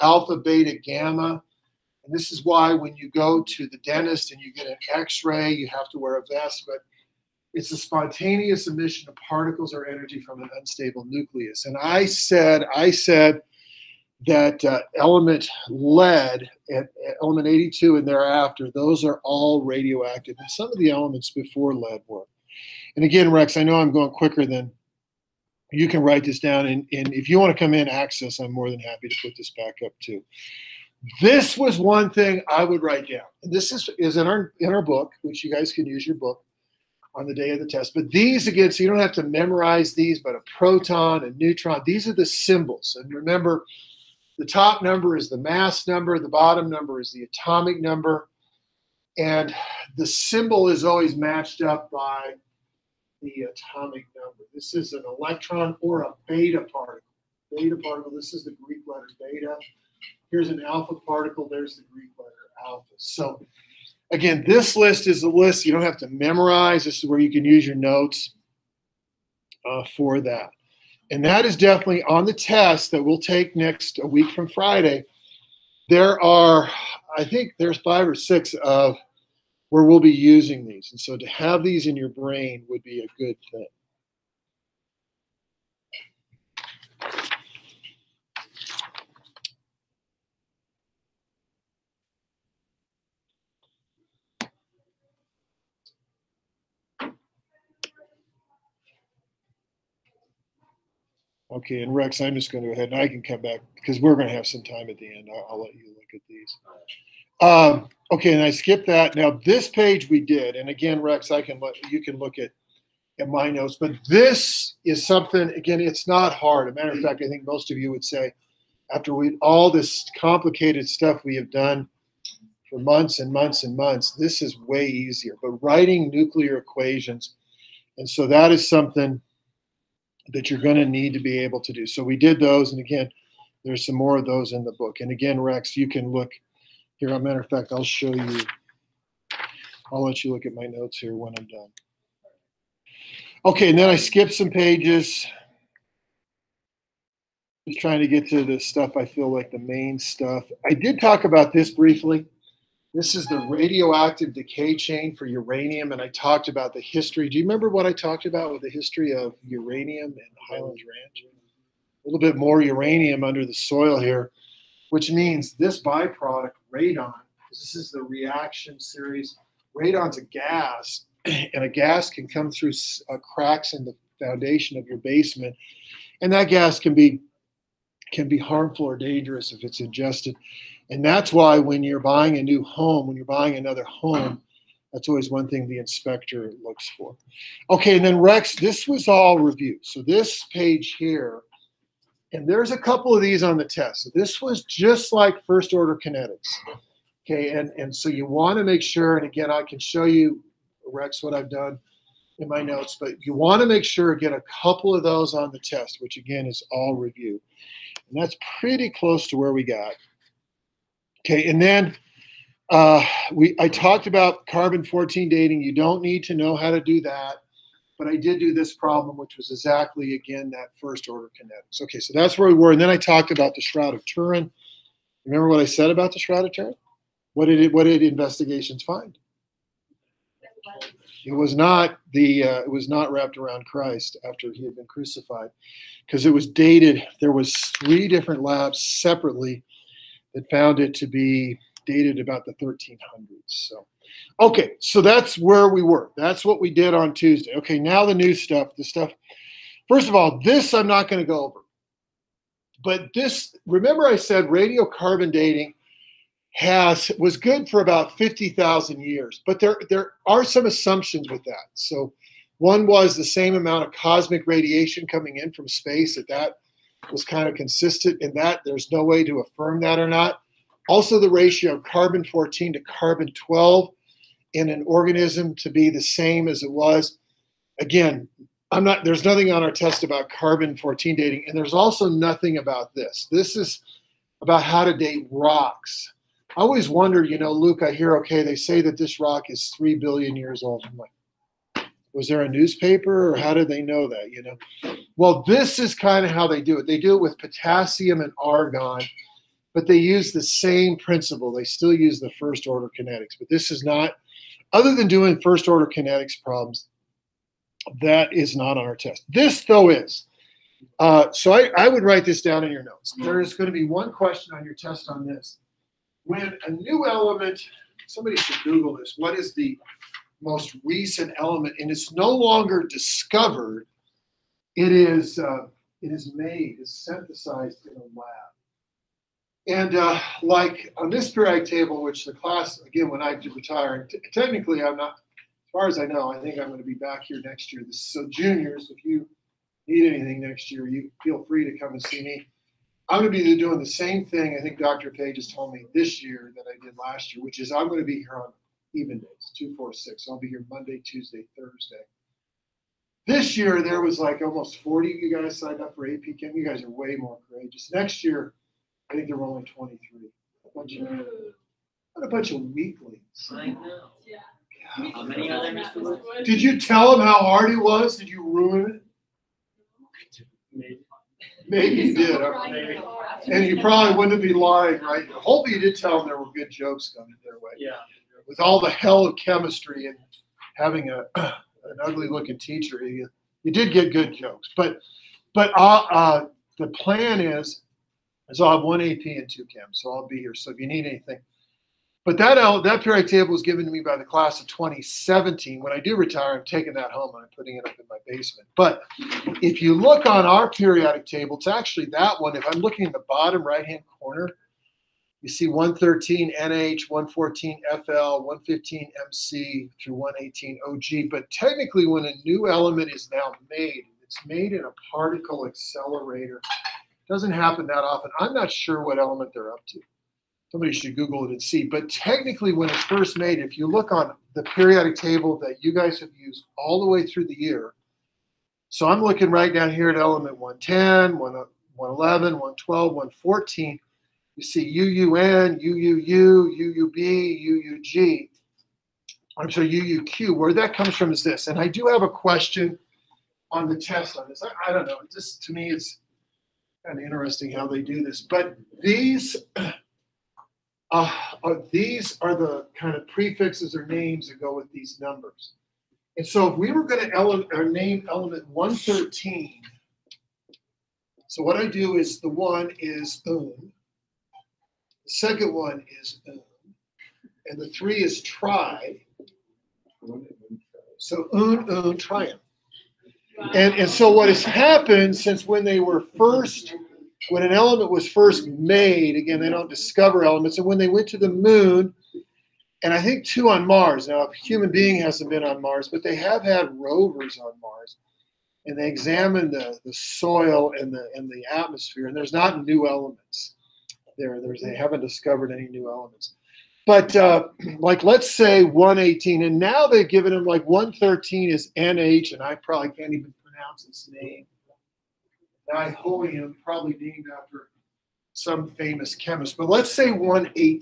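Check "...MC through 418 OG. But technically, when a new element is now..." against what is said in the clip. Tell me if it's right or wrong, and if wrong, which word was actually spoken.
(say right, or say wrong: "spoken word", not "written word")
wrong: "118", not "418".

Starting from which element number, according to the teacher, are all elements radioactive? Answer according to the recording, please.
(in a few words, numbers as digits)
82.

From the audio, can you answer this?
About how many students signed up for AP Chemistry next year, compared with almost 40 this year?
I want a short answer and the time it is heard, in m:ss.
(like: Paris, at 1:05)
23, at 5:59.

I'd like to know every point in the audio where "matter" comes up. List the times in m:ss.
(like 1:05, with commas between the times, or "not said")
1:56, 2:17.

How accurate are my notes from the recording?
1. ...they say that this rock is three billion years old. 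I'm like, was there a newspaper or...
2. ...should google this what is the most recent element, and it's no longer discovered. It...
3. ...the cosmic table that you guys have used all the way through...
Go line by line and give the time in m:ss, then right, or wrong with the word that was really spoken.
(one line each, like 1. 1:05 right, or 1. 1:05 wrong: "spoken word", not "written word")
1. 4:48 right
2. 5:18 right
3. 7:04 wrong: "periodic", not "cosmic".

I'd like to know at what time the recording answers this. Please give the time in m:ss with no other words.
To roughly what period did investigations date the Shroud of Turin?
4:02.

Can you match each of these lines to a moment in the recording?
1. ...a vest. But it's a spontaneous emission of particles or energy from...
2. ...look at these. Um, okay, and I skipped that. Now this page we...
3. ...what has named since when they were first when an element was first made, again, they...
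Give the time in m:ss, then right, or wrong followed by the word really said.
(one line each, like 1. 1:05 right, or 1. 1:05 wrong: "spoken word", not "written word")
1. 0:06 right
2. 1:45 right
3. 7:54 wrong: "happened", not "named".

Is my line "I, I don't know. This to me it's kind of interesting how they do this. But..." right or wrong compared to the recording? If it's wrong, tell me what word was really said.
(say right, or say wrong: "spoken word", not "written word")
right.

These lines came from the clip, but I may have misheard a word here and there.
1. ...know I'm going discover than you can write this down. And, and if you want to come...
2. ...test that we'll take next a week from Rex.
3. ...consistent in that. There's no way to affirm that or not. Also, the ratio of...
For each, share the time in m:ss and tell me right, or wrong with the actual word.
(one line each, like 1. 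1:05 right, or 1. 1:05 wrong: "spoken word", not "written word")
1. 0:23 wrong: "quicker", not "discover"
2. 1:12 wrong: "Friday", not "Rex"
3. 4:27 right.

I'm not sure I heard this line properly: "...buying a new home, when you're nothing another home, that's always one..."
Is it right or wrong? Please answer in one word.
wrong.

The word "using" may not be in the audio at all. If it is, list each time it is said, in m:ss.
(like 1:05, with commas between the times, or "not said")
1:20.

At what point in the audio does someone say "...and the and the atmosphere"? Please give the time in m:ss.
8:10.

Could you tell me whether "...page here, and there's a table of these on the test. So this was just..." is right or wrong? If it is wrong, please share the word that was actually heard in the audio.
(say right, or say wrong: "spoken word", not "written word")
wrong: "couple", not "table".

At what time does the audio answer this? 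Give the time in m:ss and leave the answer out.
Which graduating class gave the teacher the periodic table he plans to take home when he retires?
6:34.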